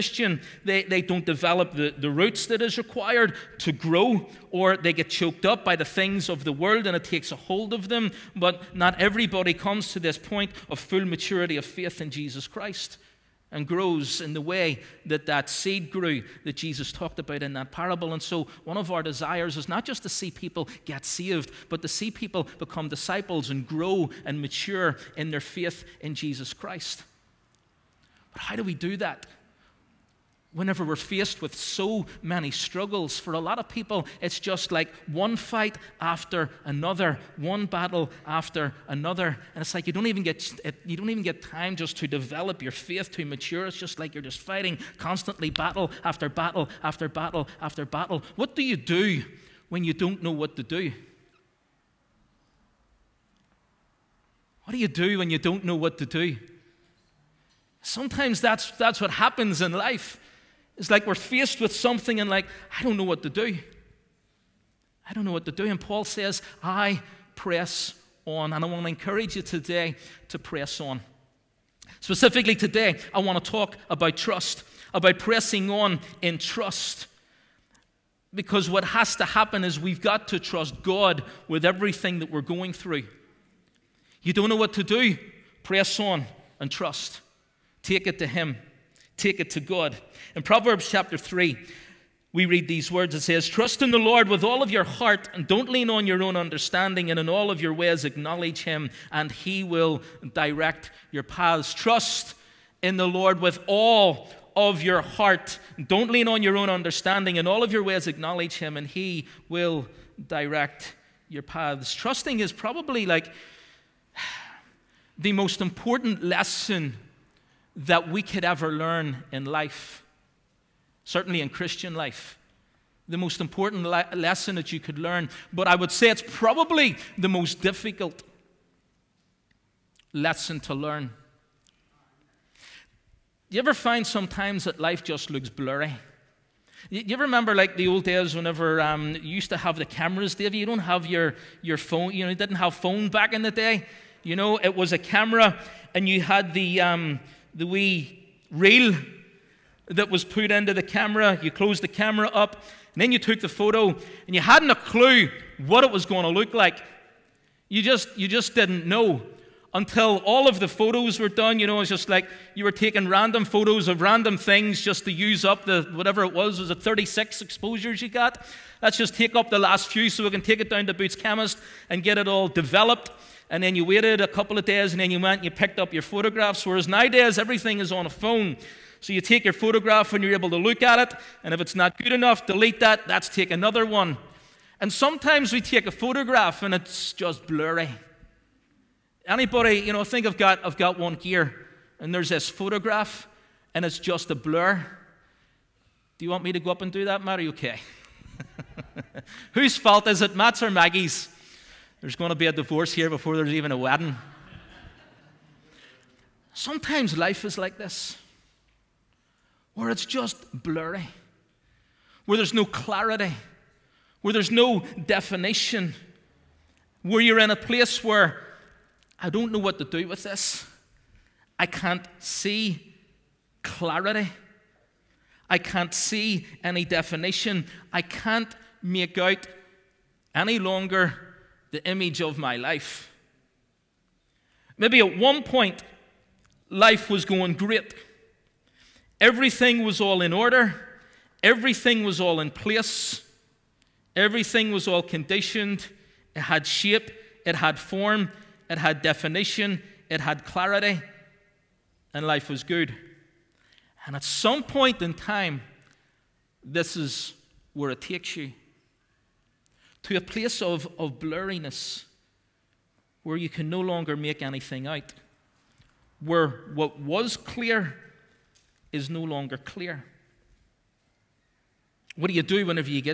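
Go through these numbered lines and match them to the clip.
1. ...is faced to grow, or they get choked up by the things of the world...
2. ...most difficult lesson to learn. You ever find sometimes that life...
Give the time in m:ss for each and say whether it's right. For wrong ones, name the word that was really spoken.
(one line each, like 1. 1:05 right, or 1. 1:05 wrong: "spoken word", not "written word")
1. 0:02 wrong: "required", not "faced"
2. 2:07 right.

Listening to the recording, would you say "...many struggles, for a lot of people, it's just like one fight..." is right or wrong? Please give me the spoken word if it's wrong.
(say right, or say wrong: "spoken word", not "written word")
right.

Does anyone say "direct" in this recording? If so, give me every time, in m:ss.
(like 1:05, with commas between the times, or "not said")
1:40, 1:50.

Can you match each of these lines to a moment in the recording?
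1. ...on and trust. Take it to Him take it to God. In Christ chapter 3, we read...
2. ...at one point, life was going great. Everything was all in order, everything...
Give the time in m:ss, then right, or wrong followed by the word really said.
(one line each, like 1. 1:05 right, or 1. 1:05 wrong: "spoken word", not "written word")
1. 1:25 wrong: "Proverbs", not "Christ"
2. 3:54 right.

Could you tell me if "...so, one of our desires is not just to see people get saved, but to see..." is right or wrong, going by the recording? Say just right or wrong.
right.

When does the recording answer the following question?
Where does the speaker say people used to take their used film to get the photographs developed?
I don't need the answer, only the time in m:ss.
2:50.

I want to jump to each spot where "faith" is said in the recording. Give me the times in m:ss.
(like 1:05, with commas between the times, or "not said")
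0:11, 0:25, 0:42.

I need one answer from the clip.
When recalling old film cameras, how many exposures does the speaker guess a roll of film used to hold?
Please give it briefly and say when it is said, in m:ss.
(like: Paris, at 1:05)
36, at 2:46.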